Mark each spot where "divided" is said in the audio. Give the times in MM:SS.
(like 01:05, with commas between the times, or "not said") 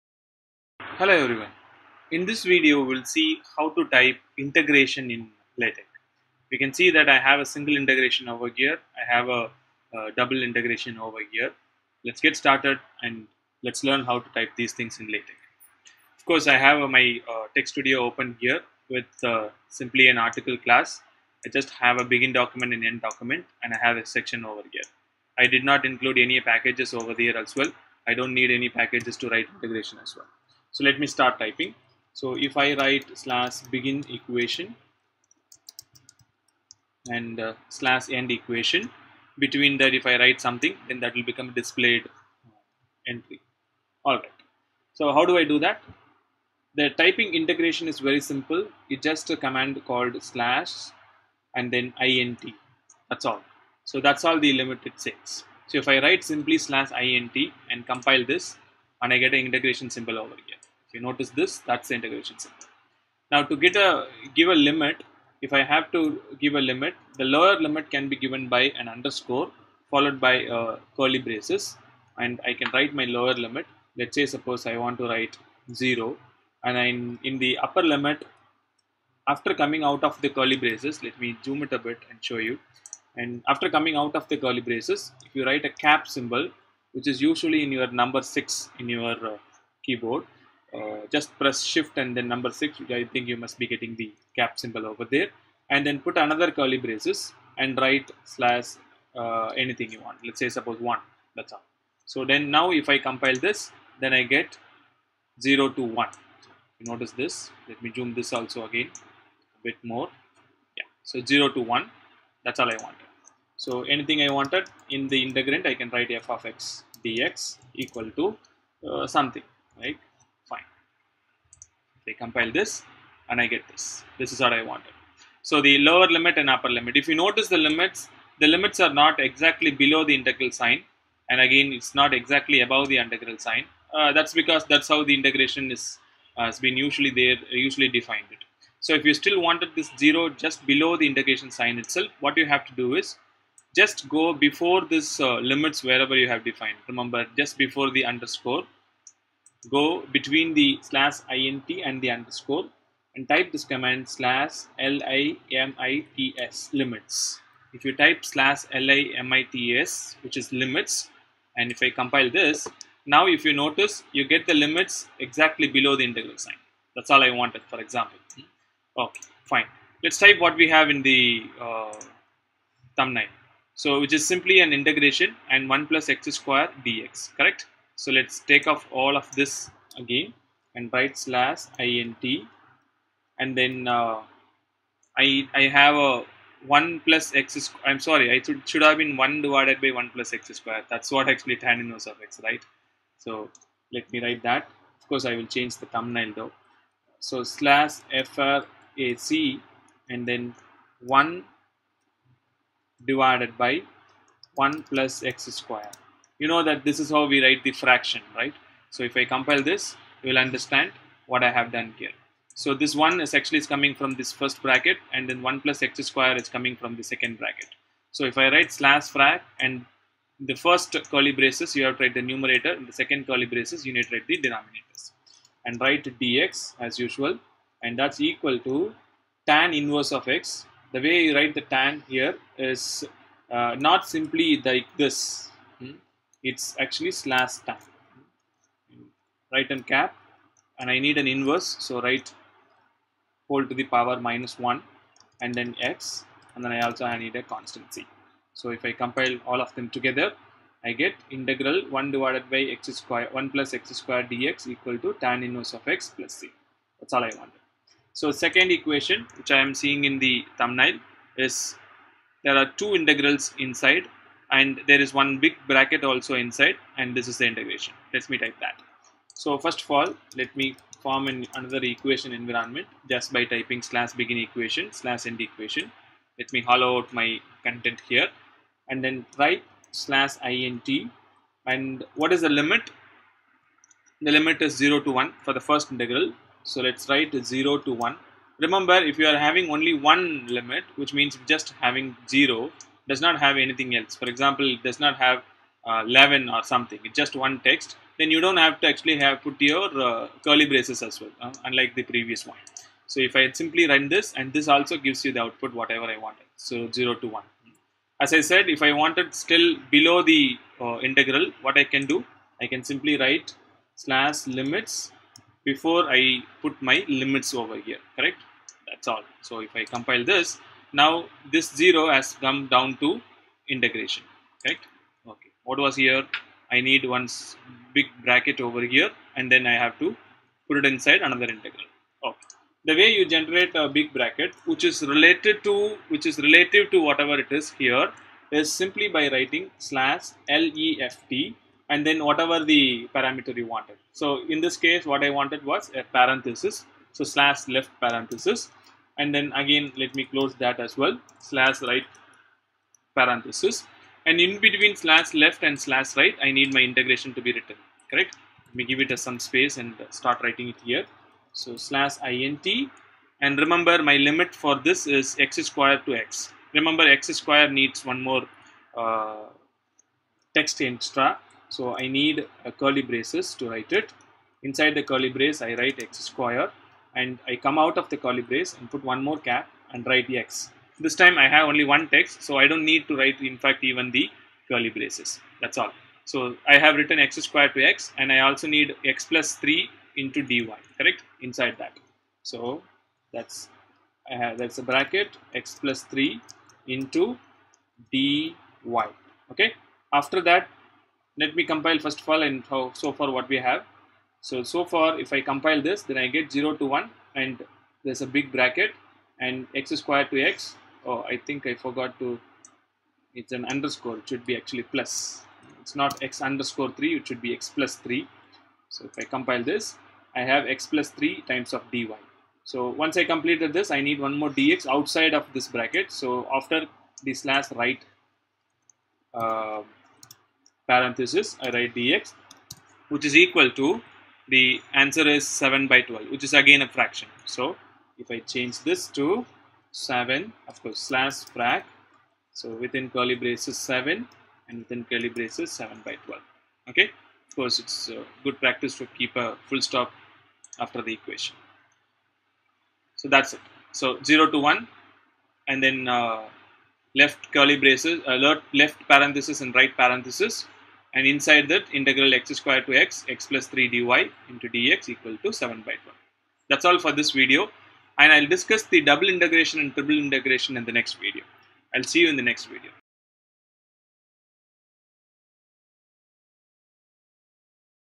03:09, 03:23, 04:12.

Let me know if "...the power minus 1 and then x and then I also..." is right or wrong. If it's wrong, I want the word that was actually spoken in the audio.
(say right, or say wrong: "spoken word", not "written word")
right.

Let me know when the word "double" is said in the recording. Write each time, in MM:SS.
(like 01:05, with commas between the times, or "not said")
00:10, 07:49.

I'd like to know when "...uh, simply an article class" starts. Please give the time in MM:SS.
00:19.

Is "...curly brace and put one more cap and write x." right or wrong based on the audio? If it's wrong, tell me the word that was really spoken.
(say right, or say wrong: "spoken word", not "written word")
right.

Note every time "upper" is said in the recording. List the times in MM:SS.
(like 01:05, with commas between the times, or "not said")
01:17, 02:06.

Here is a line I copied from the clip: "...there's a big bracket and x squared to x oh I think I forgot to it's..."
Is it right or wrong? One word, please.
right.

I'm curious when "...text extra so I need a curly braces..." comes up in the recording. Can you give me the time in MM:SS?
06:10.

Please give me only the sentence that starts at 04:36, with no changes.
Let me hollow out my content here and then type slash int and what is the limit?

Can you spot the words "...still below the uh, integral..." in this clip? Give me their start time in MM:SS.
05:09.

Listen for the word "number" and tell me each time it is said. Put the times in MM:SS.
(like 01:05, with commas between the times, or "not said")
01:28, 01:32.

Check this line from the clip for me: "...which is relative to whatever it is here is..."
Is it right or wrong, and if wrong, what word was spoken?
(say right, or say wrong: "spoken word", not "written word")
right.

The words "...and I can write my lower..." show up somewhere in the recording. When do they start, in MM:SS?
01:12.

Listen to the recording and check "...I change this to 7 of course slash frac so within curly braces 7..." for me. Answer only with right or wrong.
right.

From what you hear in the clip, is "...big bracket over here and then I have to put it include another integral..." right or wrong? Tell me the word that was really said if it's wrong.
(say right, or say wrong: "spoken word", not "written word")
wrong: "inside", not "include".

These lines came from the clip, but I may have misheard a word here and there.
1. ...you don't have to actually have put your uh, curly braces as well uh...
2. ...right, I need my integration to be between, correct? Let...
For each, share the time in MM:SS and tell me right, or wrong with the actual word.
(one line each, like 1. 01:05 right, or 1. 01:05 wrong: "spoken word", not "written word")
1. 04:58 right
2. 05:56 wrong: "written", not "between".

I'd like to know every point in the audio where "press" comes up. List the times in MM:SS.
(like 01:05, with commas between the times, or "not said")
01:31.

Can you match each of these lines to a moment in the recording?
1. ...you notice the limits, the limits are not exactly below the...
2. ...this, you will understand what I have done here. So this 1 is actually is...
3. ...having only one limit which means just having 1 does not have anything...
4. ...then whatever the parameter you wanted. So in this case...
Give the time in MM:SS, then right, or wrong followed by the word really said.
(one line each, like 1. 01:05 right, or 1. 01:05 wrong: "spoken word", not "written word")
1. 02:07 right
2. 03:29 right
3. 04:49 wrong: "0", not "1"
4. 05:42 right.